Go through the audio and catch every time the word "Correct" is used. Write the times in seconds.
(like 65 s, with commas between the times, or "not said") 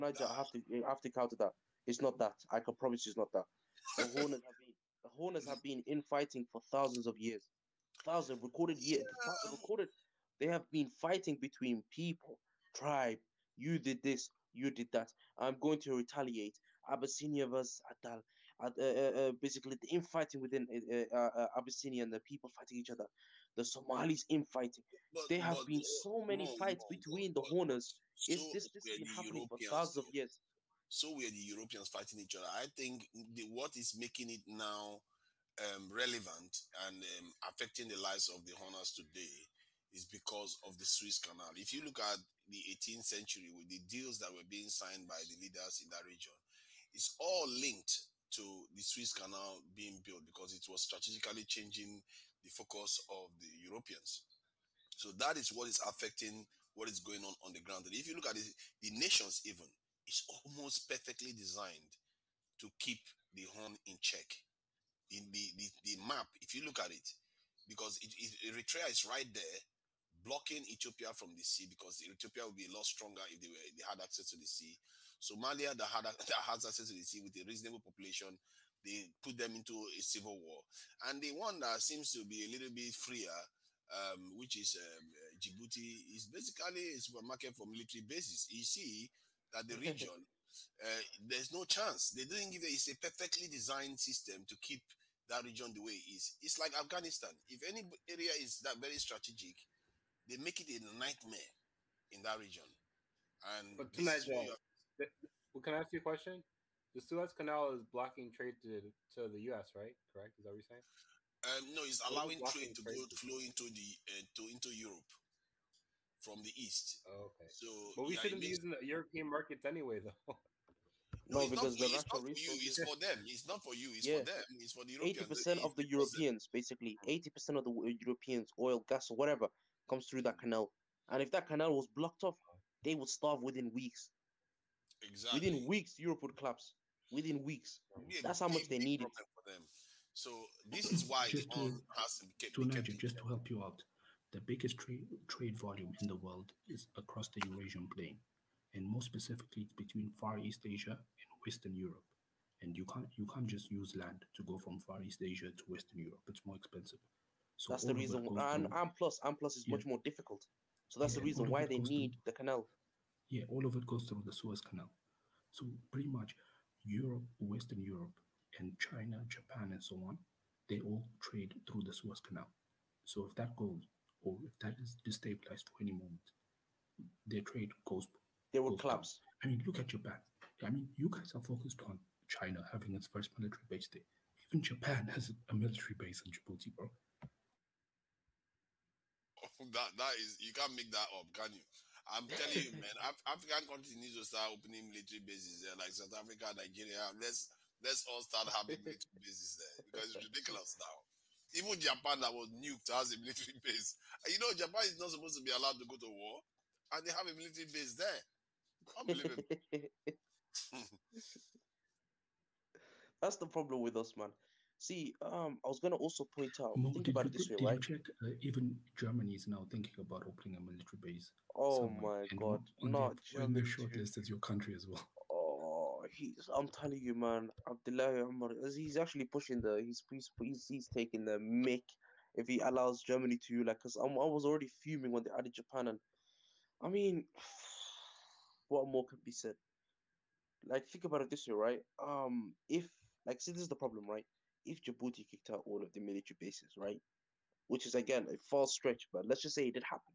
110 s.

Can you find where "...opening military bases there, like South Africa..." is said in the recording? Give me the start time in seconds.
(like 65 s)
194 s.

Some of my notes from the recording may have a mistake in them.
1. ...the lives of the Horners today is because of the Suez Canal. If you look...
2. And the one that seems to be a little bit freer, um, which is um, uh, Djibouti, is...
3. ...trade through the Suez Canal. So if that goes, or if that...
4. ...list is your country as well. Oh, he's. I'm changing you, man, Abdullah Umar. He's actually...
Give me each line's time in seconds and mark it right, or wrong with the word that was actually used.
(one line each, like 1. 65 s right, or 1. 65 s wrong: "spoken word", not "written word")
1. 37 s right
2. 81 s right
3. 171 s right
4. 223 s wrong: "telling", not "changing".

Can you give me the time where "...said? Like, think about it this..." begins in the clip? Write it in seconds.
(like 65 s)
239 s.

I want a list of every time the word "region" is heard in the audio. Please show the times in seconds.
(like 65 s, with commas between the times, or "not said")
46 s, 89 s, 95 s, 102 s.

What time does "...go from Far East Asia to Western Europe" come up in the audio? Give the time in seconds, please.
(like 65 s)
154 s.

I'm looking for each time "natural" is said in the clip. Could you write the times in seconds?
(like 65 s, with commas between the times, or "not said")
121 s.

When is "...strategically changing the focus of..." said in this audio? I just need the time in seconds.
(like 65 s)
50 s.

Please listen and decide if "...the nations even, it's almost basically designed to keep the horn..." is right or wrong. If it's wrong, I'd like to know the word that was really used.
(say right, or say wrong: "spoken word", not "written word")
wrong: "perfectly", not "basically".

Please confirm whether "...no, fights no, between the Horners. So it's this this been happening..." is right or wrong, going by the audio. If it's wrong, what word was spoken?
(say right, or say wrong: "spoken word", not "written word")
right.